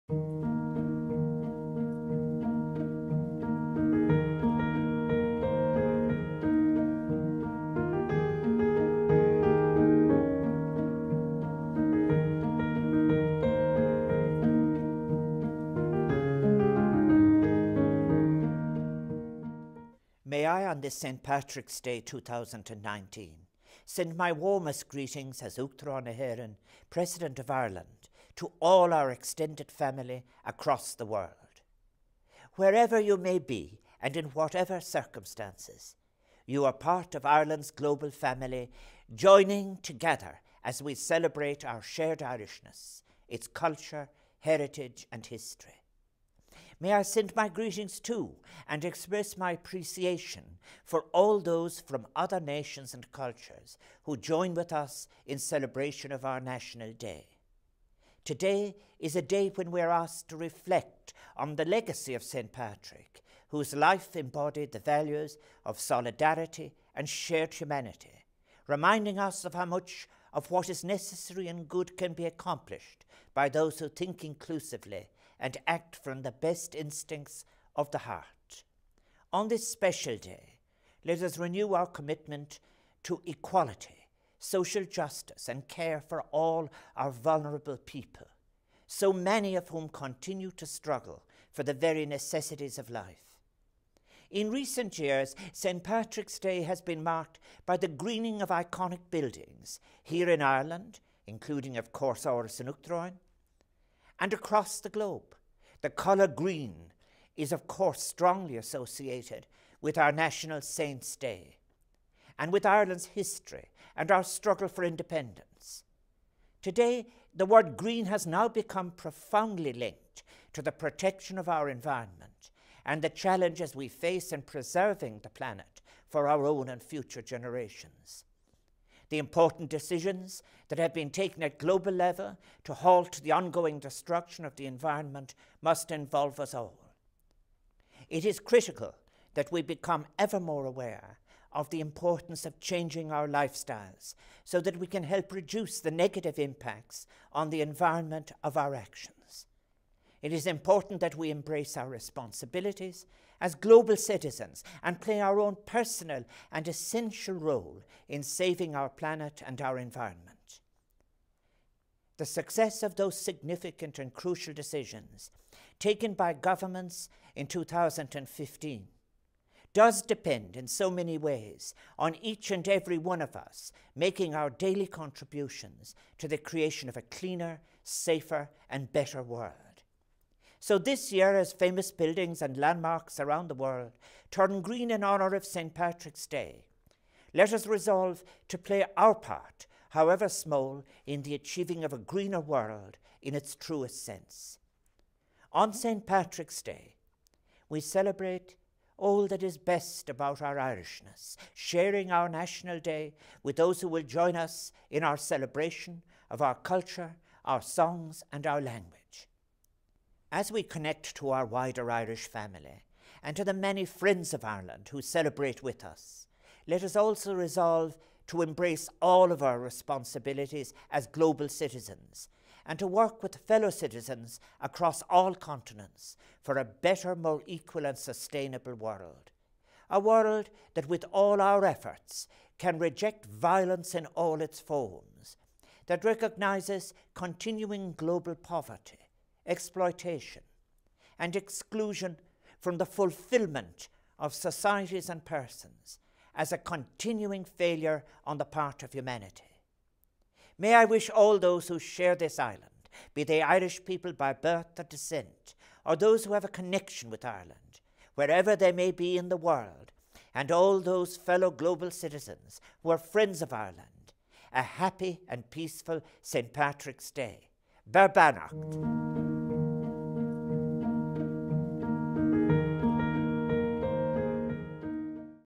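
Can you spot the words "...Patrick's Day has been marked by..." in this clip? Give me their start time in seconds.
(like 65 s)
95 s.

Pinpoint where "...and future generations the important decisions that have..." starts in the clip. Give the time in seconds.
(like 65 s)
126 s.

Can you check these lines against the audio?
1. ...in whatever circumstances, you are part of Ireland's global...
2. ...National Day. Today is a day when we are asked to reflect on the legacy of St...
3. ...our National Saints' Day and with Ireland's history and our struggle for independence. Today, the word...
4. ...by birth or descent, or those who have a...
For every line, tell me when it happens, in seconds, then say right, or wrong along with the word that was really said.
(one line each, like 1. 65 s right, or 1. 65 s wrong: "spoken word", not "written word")
1. 34 s right
2. 56 s right
3. 109 s right
4. 254 s right.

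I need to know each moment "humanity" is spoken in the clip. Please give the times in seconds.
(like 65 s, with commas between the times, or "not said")
67 s, 248 s.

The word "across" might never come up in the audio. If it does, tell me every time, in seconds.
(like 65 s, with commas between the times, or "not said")
30 s, 104 s, 224 s.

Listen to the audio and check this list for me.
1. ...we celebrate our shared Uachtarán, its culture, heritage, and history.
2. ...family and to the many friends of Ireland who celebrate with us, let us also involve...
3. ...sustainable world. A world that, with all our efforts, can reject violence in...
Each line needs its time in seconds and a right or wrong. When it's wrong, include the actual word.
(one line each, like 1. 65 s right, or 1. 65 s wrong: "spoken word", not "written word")
1. 40 s wrong: "Irishness", not "Uachtarán"
2. 212 s wrong: "resolve", not "involve"
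3. 227 s right.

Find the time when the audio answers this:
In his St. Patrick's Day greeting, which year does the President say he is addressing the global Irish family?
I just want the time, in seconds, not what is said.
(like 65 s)
21 s.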